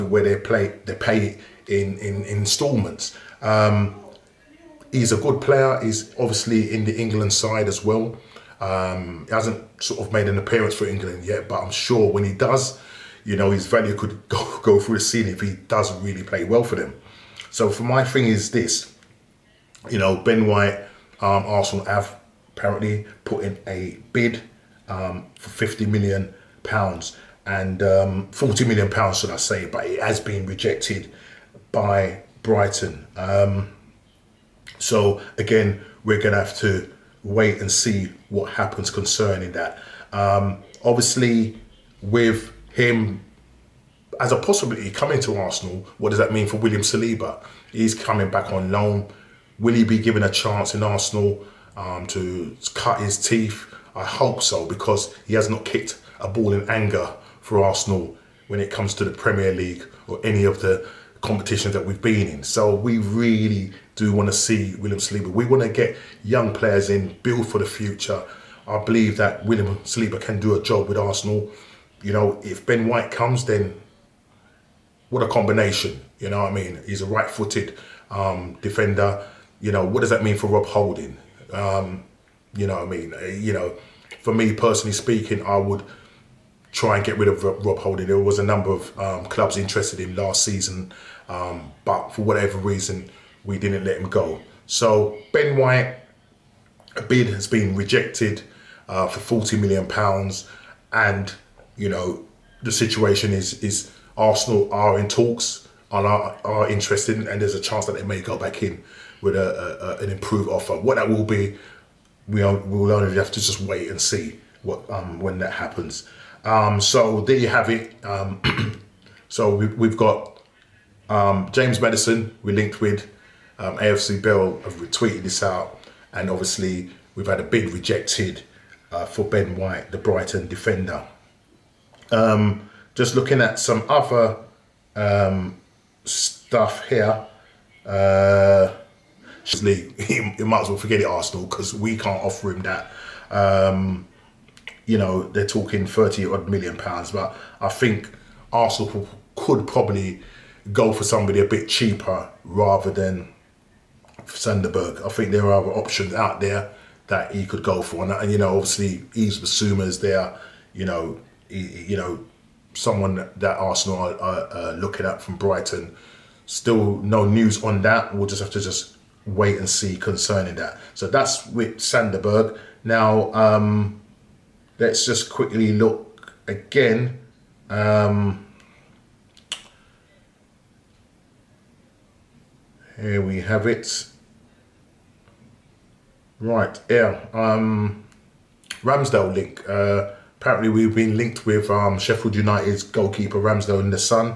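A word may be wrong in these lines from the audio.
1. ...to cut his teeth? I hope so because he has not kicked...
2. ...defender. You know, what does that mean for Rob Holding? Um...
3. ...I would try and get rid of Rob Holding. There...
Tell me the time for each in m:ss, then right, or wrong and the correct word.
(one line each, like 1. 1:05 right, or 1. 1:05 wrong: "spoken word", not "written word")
1. 0:52 right
2. 1:18 right
3. 1:25 right.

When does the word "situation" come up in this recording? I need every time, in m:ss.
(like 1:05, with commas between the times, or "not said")
1:42.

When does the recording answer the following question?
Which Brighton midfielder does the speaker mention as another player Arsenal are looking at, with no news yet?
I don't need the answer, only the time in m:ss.
2:39.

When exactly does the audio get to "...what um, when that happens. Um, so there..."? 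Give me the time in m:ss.
1:54.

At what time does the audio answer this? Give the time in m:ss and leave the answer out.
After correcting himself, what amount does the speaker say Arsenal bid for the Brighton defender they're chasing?
0:28.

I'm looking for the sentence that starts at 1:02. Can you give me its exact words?
So we really do want to see William Saliba.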